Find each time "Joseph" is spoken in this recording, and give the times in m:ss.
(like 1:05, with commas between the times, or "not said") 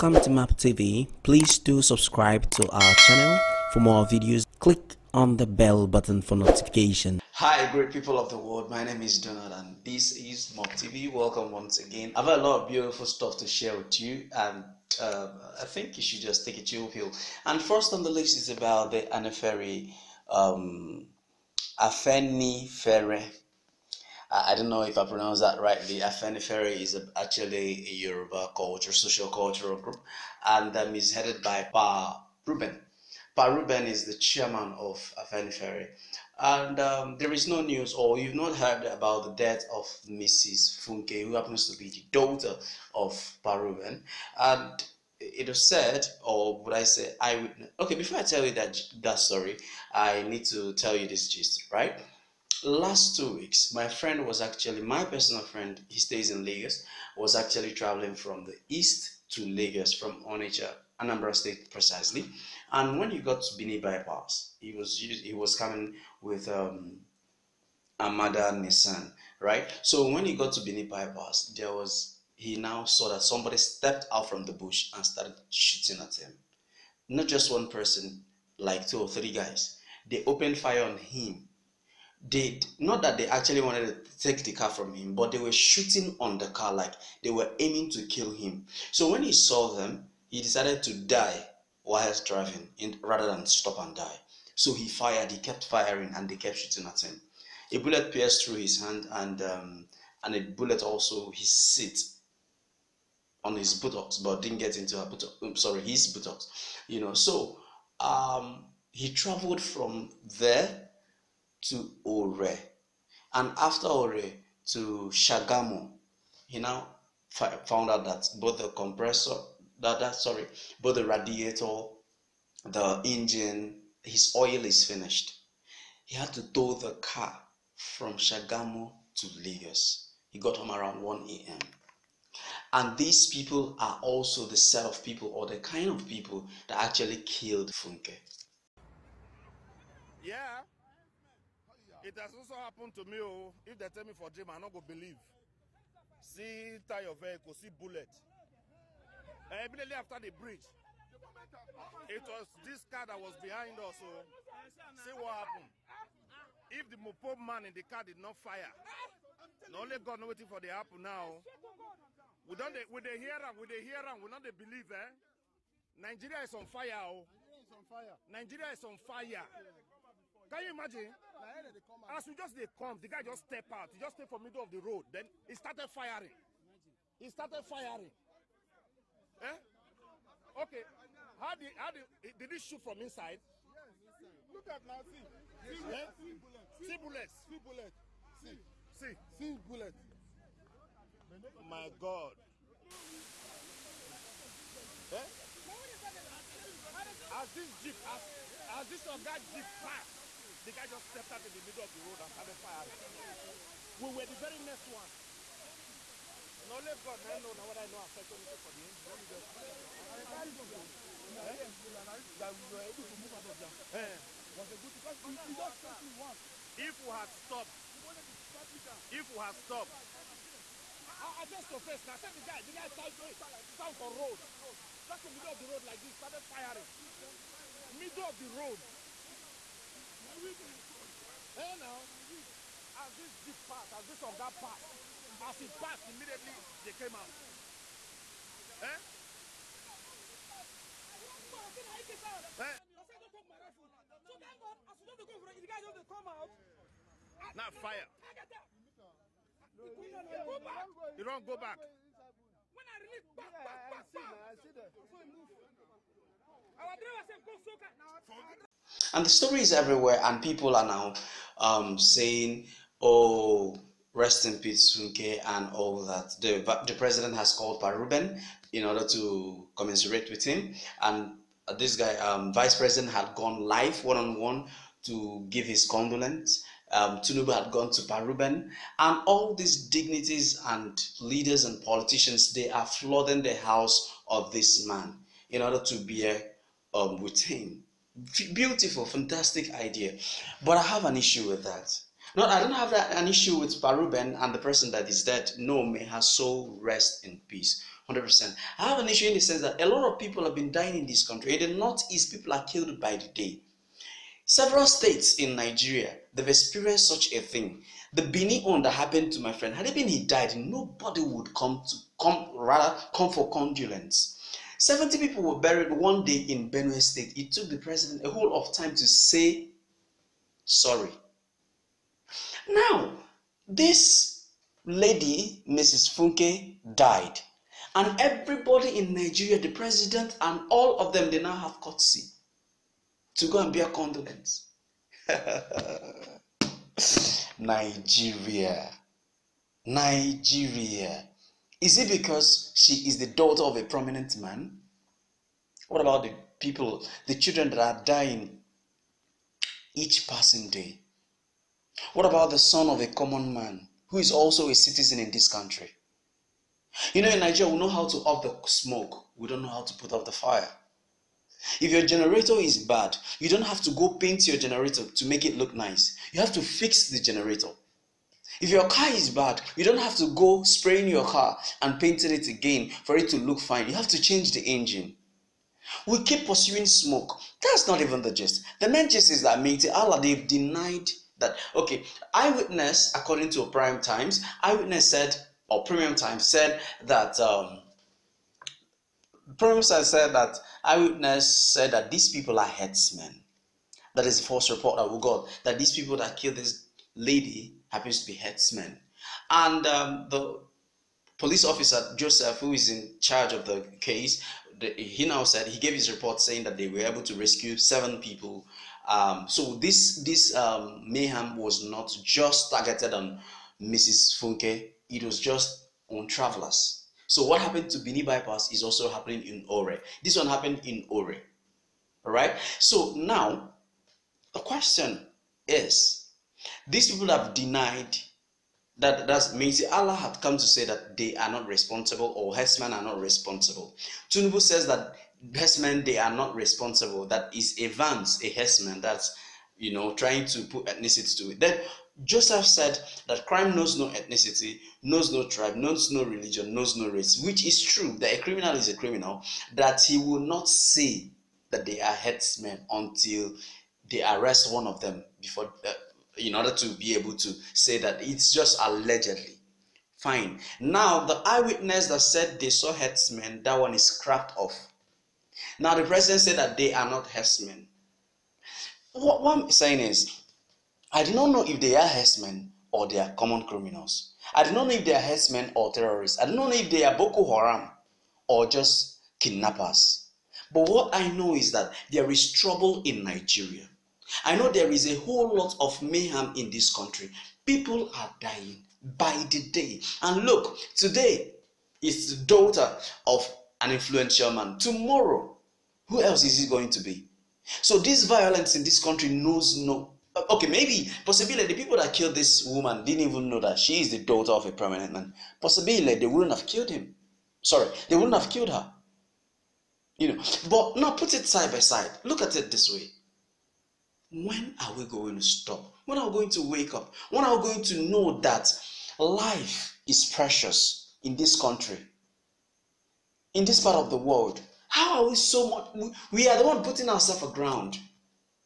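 6:42, 7:22.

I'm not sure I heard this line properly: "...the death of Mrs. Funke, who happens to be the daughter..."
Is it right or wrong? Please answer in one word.
right.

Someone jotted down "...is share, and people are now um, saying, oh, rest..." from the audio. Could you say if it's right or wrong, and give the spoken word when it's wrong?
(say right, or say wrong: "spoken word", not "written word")
wrong: "everywhere", not "share".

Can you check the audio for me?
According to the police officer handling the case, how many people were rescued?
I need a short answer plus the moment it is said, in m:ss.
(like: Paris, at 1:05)
7, at 6:47.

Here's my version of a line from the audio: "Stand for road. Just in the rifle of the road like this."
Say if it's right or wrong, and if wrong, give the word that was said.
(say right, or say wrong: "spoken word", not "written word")
wrong: "middle", not "rifle".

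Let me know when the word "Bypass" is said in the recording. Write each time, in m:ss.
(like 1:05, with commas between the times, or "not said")
1:03, 1:10, 6:58.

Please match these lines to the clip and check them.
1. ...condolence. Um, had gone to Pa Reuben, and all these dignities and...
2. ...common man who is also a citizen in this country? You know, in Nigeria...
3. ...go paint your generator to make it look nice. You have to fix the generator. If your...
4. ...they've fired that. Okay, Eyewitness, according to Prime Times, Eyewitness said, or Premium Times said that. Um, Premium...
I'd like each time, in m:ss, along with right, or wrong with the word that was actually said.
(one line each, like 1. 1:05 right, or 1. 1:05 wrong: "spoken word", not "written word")
1. 4:35 right
2. 5:53 right
3. 6:03 right
4. 6:20 wrong: "denied", not "fired".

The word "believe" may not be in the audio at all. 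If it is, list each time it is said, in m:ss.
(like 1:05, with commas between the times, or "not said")
2:24, 2:44.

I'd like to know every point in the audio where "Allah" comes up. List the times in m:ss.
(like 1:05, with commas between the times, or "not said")
6:19, 7:09.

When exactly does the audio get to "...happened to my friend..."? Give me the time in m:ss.
5:08.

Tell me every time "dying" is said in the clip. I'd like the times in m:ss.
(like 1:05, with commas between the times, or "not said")
5:00, 5:48, 8:08.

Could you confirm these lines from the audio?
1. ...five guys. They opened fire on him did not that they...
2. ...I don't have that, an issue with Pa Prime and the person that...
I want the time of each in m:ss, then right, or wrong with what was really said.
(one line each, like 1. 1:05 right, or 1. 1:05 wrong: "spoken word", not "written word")
1. 1:19 wrong: "three", not "five"
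2. 4:52 wrong: "Reuben", not "Prime".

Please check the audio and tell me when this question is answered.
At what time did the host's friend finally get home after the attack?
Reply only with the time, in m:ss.
2:11.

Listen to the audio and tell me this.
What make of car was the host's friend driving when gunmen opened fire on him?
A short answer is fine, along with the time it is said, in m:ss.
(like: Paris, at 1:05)
Nissan, at 1:08.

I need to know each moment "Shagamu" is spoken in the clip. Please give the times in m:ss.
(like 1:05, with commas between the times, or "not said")
1:55, 2:08.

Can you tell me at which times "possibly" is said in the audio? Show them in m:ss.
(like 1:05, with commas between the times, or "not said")
8:21, 8:25.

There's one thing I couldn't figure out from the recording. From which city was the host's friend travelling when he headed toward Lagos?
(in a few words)
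Onitsha.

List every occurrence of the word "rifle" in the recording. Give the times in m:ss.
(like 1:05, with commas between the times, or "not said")
4:03.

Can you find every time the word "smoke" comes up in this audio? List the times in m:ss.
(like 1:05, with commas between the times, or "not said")
5:58, 6:16.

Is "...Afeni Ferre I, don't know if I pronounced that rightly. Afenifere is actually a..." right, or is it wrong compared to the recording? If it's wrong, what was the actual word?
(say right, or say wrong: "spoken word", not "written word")
right.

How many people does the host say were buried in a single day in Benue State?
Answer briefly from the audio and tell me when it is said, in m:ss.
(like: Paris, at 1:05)
70, at 5:14.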